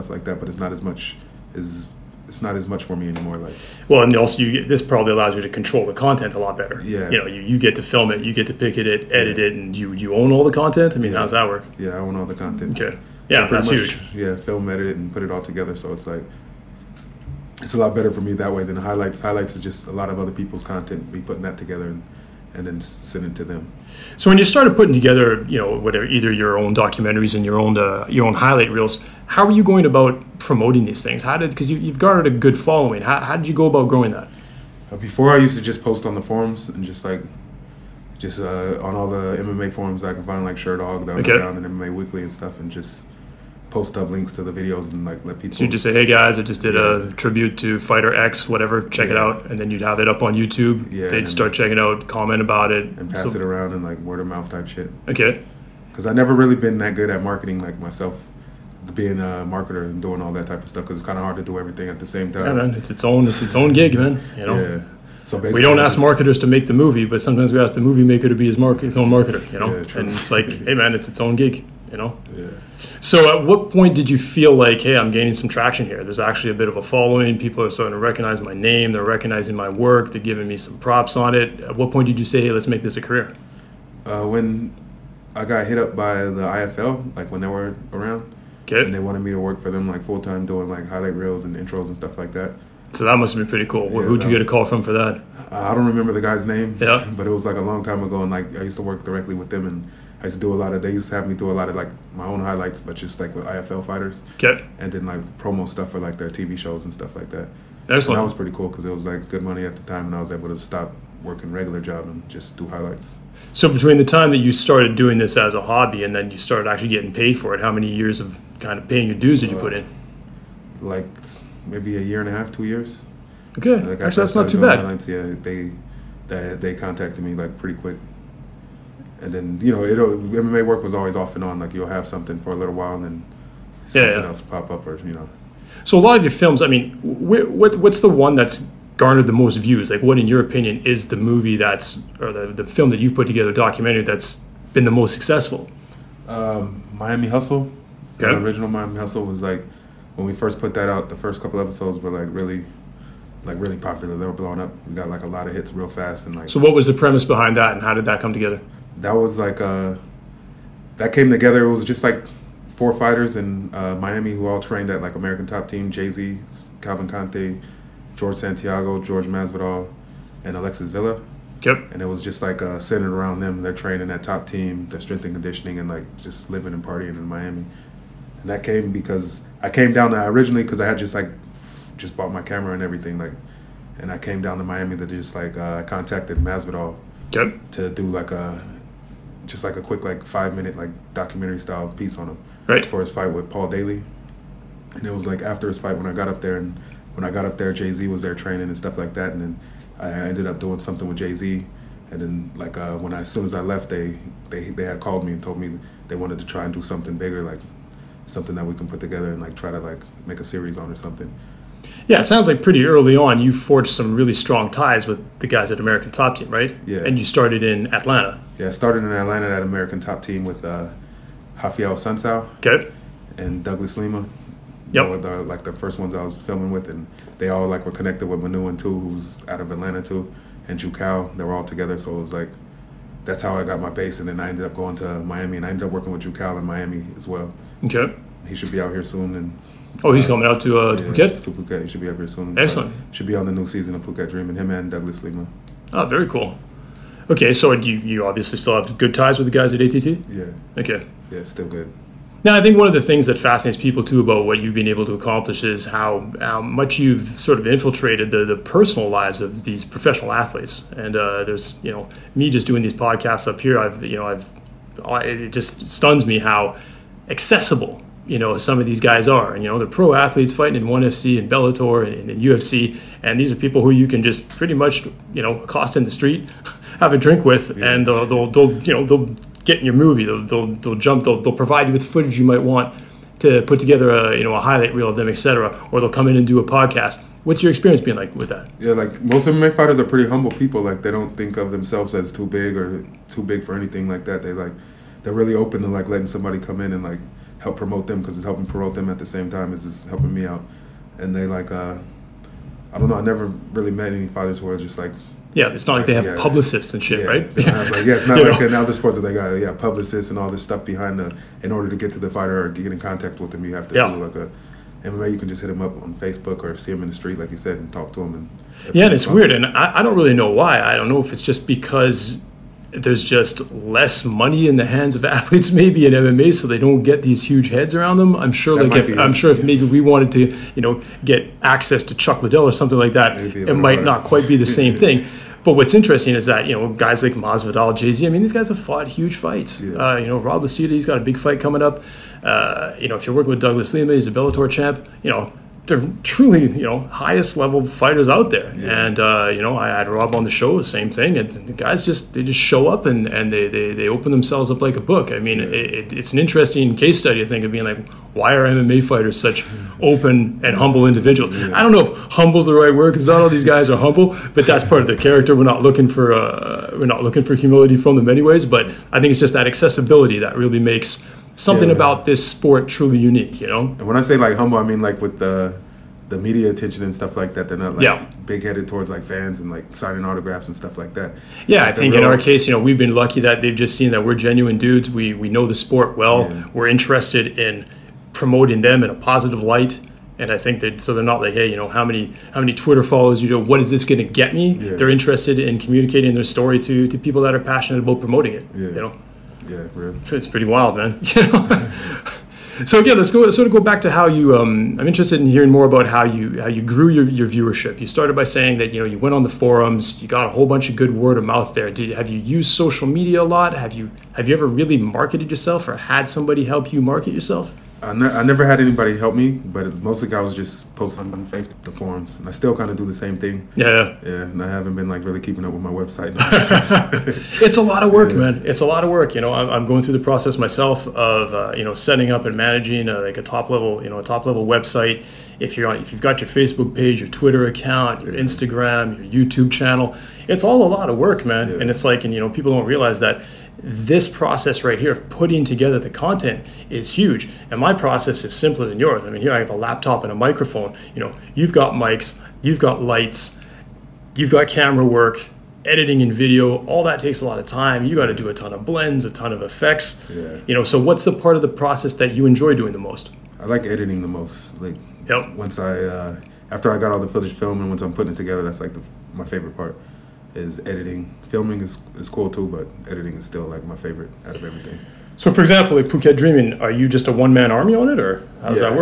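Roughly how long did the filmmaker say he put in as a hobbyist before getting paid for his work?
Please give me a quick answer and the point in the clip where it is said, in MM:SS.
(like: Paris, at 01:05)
a year and a half, two years, at 02:01.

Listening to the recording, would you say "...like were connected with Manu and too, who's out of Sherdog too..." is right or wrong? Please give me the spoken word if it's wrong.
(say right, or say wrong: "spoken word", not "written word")
wrong: "Atlanta", not "Sherdog".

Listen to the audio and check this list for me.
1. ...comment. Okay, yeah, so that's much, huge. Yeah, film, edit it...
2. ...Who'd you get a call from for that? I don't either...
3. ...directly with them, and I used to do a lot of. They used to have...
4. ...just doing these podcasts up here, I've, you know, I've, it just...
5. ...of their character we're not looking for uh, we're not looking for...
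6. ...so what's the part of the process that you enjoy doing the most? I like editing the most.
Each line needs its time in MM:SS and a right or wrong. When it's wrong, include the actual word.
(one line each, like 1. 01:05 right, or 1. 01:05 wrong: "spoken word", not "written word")
1. 00:12 wrong: "content", not "comment"
2. 01:34 wrong: "remember", not "either"
3. 01:39 right
4. 04:22 right
5. 06:04 right
6. 07:40 right.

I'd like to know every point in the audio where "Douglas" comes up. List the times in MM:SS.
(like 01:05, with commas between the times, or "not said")
03:43, 04:04, 05:43.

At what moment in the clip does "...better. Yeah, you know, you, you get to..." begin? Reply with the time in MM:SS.
00:06.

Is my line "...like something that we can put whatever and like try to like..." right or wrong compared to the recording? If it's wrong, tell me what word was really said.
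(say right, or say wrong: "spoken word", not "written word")
wrong: "together", not "whatever".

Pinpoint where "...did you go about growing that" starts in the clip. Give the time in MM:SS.
00:33.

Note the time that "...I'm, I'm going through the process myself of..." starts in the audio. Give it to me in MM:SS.
07:09.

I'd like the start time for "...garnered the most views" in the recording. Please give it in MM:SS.
02:18.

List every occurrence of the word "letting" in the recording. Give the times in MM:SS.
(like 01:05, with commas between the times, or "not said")
04:56.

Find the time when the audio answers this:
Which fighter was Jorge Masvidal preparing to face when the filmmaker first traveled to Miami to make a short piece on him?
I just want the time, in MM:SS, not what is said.
03:13.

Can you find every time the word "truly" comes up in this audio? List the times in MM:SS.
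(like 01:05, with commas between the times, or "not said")
05:46, 06:12.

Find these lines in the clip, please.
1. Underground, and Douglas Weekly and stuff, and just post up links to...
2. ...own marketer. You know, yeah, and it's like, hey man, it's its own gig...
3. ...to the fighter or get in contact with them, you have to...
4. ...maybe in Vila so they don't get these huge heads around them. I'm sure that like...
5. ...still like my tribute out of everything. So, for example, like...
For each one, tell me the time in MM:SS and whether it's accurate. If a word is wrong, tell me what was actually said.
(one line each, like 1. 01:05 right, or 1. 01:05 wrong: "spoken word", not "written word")
1. 00:41 wrong: "MMA", not "Douglas"
2. 01:08 right
3. 05:12 right
4. 05:25 wrong: "MMA", not "Vila"
5. 07:53 wrong: "favorite", not "tribute".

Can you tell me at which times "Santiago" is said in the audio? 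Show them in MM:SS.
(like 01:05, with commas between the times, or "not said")
02:48.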